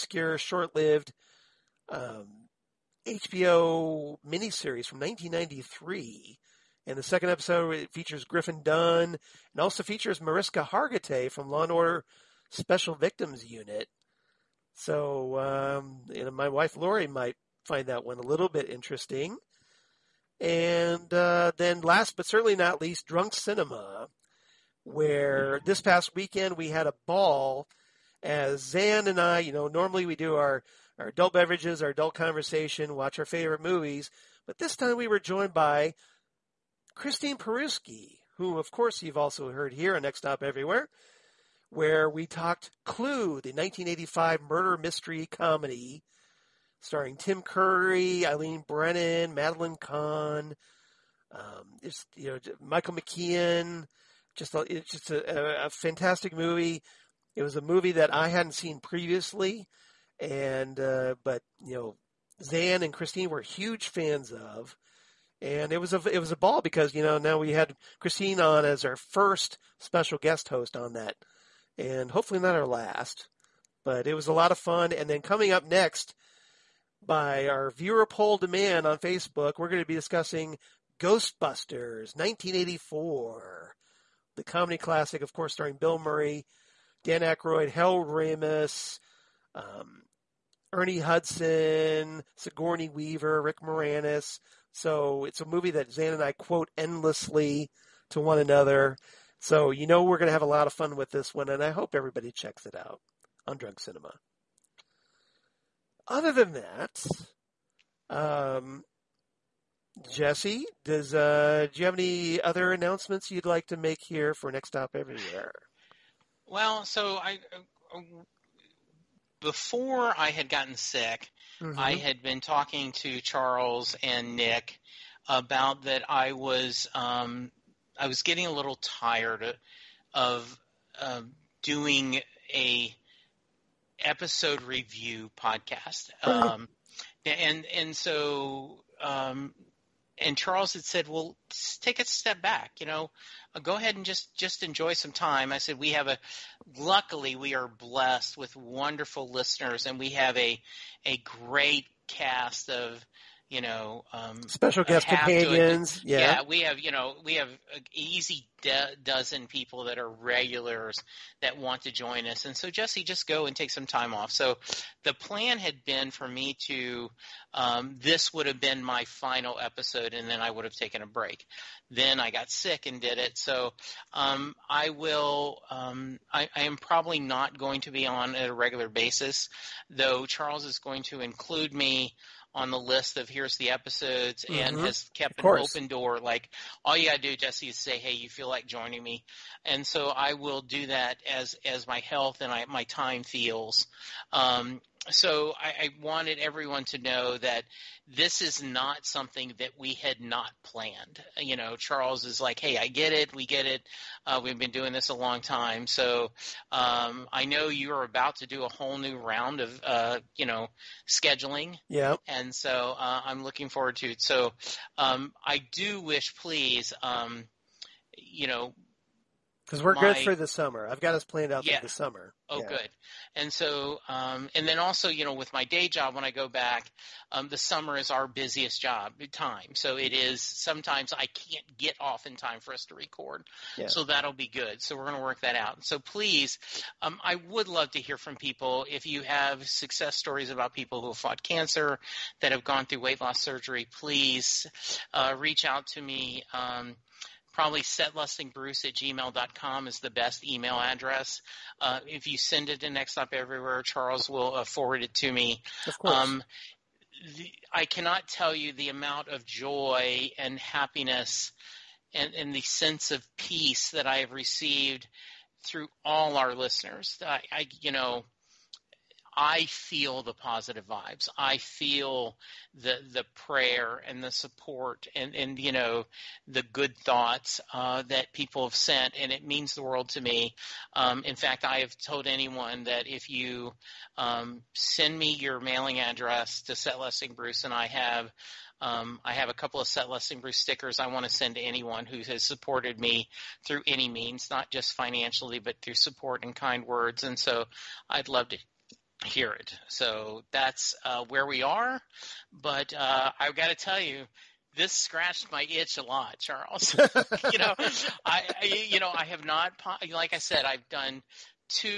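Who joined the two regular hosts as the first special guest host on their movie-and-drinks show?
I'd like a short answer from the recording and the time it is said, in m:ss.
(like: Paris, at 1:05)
Christine Peruski, at 0:36.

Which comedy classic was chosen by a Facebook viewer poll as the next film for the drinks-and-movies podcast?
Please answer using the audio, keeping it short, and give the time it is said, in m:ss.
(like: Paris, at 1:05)
Ghostbusters, at 1:20.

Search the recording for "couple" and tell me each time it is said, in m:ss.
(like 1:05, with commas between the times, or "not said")
4:49.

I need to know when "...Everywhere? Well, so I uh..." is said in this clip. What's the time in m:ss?
1:54.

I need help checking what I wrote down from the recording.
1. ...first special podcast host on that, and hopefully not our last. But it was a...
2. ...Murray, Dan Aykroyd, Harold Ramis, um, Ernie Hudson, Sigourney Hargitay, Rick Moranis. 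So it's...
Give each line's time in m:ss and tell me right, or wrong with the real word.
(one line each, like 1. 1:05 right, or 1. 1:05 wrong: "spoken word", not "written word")
1. 1:08 wrong: "guest", not "podcast"
2. 1:25 wrong: "Weaver", not "Hargitay".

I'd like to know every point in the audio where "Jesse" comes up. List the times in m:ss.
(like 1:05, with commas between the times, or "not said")
1:50, 2:42, 3:07.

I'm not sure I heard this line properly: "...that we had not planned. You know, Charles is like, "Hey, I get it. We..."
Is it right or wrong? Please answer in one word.
right.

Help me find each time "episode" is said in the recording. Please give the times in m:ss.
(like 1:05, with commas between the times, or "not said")
0:07, 2:14, 2:49, 3:03.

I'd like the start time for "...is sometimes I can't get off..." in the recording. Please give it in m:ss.
3:50.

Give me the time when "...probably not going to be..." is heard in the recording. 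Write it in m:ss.
2:56.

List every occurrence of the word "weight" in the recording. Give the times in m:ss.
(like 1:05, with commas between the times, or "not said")
4:02.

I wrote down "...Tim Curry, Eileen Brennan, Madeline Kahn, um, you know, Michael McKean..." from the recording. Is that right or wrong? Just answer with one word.
right.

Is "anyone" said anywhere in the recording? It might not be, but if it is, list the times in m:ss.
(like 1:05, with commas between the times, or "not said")
4:42, 4:51.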